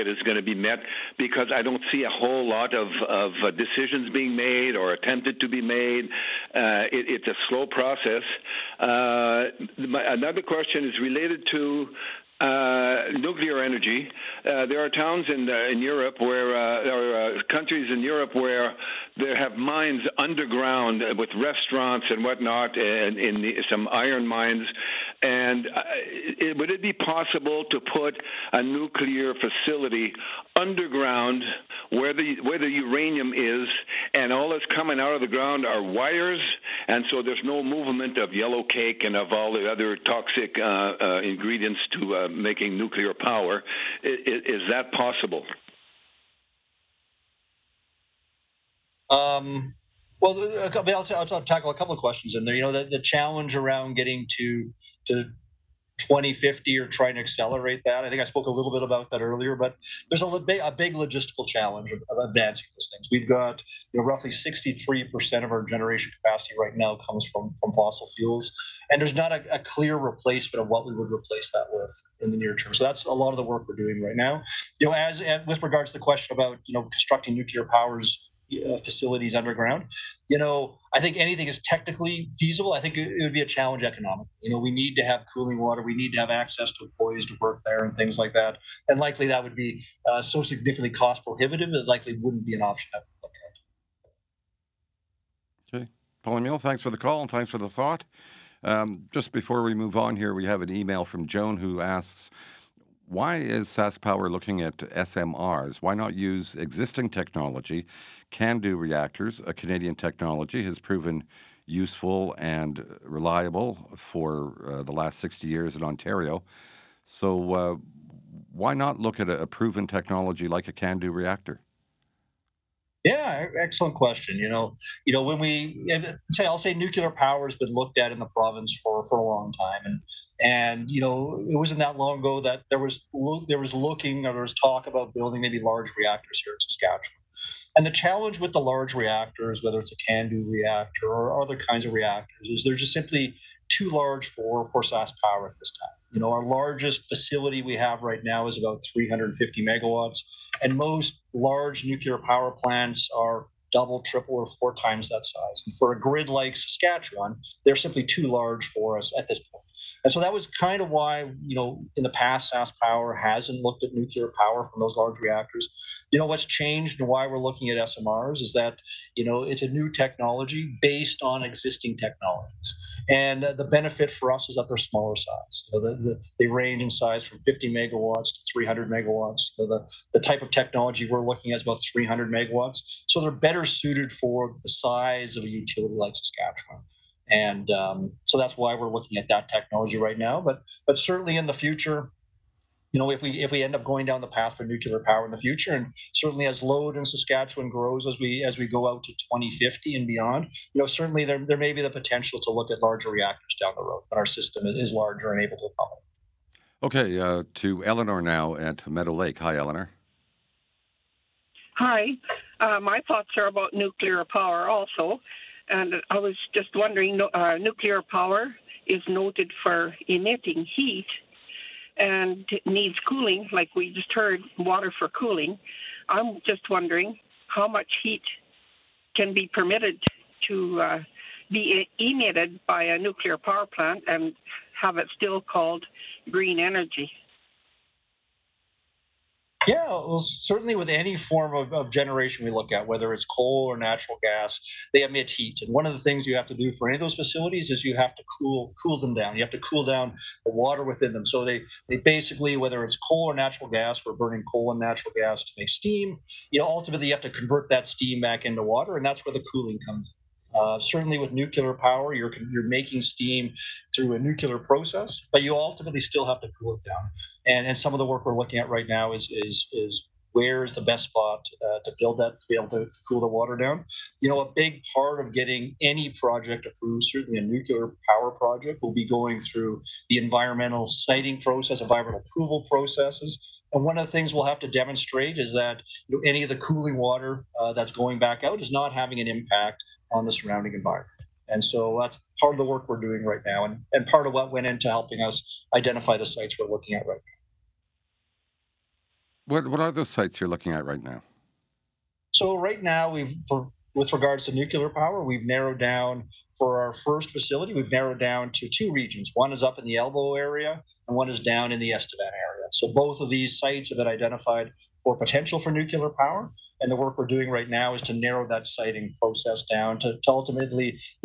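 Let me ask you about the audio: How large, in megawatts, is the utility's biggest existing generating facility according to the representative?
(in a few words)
350 megawatts.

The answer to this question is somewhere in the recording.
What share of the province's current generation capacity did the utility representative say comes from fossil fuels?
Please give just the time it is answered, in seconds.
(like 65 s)
64 s.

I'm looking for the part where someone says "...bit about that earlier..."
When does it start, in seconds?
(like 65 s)
58 s.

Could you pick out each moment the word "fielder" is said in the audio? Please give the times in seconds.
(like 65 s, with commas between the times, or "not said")
not said.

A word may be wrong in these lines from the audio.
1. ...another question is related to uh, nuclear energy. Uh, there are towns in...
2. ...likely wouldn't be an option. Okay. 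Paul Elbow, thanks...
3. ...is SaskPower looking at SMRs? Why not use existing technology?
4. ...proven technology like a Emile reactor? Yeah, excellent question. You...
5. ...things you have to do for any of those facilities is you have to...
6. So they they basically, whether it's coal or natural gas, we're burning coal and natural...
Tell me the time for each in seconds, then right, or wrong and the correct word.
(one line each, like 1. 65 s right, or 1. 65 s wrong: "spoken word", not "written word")
1. 10 s right
2. 91 s wrong: "Emile", not "Elbow"
3. 103 s right
4. 119 s wrong: "CANDU", not "Emile"
5. 245 s right
6. 251 s right.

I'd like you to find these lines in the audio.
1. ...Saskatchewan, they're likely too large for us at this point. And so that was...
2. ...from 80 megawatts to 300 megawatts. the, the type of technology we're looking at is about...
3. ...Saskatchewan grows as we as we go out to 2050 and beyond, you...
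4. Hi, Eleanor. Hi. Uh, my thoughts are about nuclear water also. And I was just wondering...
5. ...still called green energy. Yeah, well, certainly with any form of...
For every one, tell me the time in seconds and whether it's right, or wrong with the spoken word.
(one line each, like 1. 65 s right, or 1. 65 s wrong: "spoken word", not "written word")
1. 156 s wrong: "simply", not "likely"
2. 177 s wrong: "50", not "80"
3. 197 s right
4. 209 s wrong: "power", not "water"
5. 235 s right.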